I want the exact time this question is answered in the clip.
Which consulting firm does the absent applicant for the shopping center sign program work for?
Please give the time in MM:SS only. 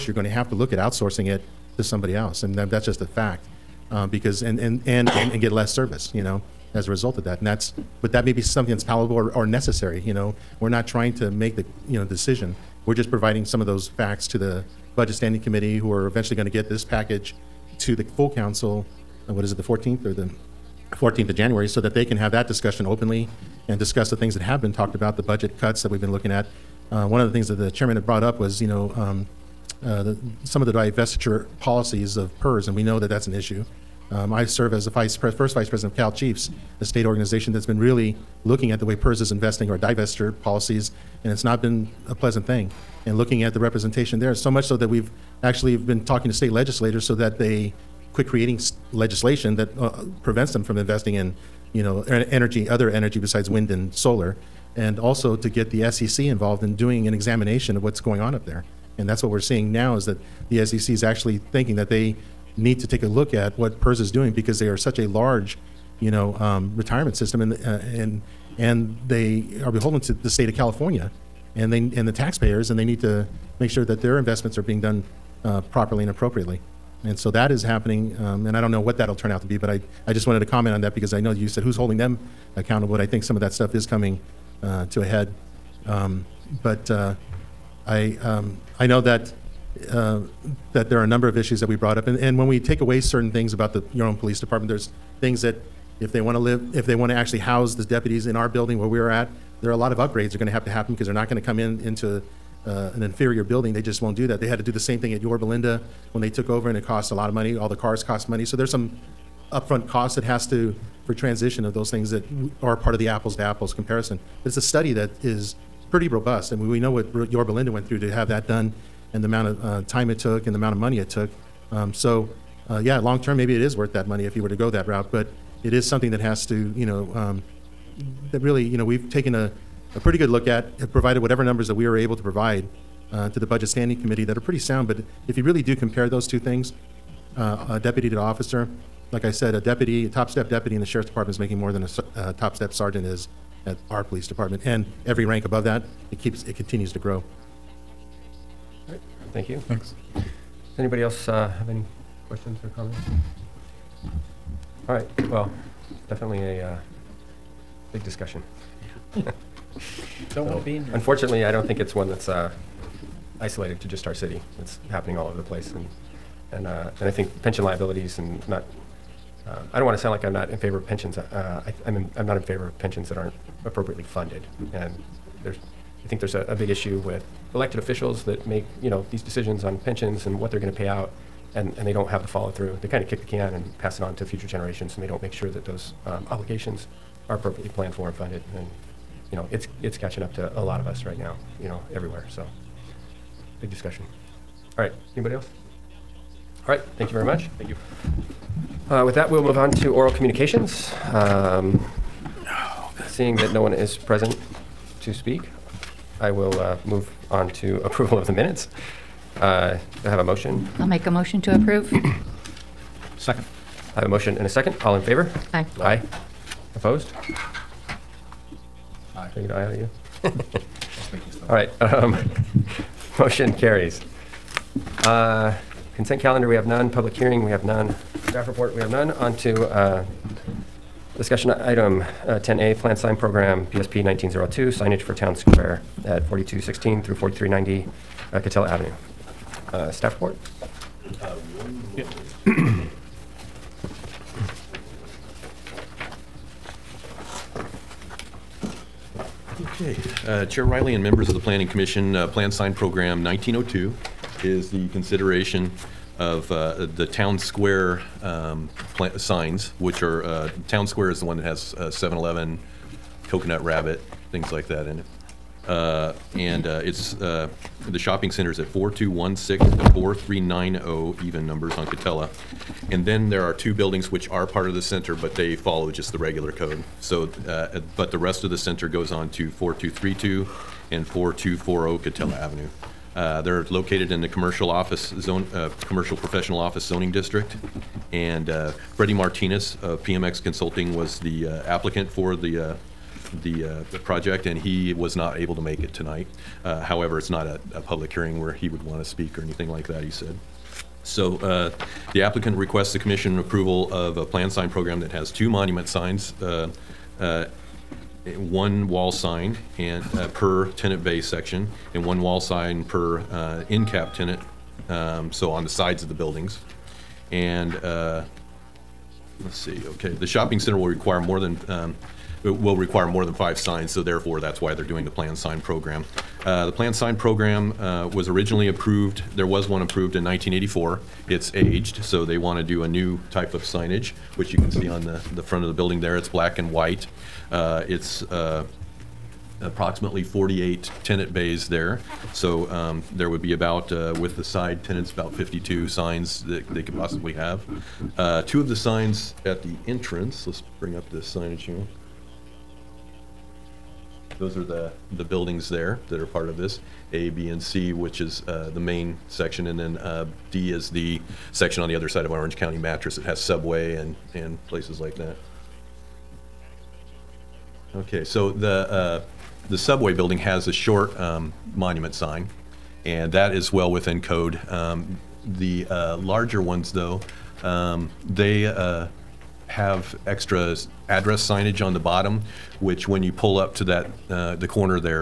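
04:50.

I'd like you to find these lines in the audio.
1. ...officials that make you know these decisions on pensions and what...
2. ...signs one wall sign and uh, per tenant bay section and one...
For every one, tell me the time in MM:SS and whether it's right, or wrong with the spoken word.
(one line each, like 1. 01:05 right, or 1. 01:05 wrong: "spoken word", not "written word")
1. 02:57 right
2. 05:05 right.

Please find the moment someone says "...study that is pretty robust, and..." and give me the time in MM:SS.
01:54.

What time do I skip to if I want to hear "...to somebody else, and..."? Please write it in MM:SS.
00:01.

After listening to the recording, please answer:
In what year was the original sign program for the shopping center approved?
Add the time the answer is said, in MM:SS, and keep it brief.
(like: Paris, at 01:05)
1984, at 05:30.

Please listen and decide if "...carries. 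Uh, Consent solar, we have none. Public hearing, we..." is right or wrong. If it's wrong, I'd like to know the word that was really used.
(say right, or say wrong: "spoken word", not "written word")
wrong: "calendar", not "solar".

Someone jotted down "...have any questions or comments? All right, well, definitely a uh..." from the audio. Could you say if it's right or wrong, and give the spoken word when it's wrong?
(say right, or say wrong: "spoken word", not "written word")
right.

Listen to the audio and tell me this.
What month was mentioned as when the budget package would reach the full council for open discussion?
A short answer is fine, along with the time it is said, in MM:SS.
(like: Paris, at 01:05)
January, at 00:20.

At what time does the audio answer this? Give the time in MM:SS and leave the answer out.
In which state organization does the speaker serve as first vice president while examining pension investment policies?
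00:35.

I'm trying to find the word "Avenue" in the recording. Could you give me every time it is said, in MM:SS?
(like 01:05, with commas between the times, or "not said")
03:58, 04:42.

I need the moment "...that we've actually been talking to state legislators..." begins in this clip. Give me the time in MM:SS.
00:44.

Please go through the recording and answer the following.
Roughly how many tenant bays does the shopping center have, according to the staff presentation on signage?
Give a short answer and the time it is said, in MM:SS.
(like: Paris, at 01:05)
48, at 05:40.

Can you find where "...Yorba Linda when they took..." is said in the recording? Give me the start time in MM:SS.
01:45.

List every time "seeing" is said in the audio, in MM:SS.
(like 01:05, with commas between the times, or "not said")
00:59, 03:23.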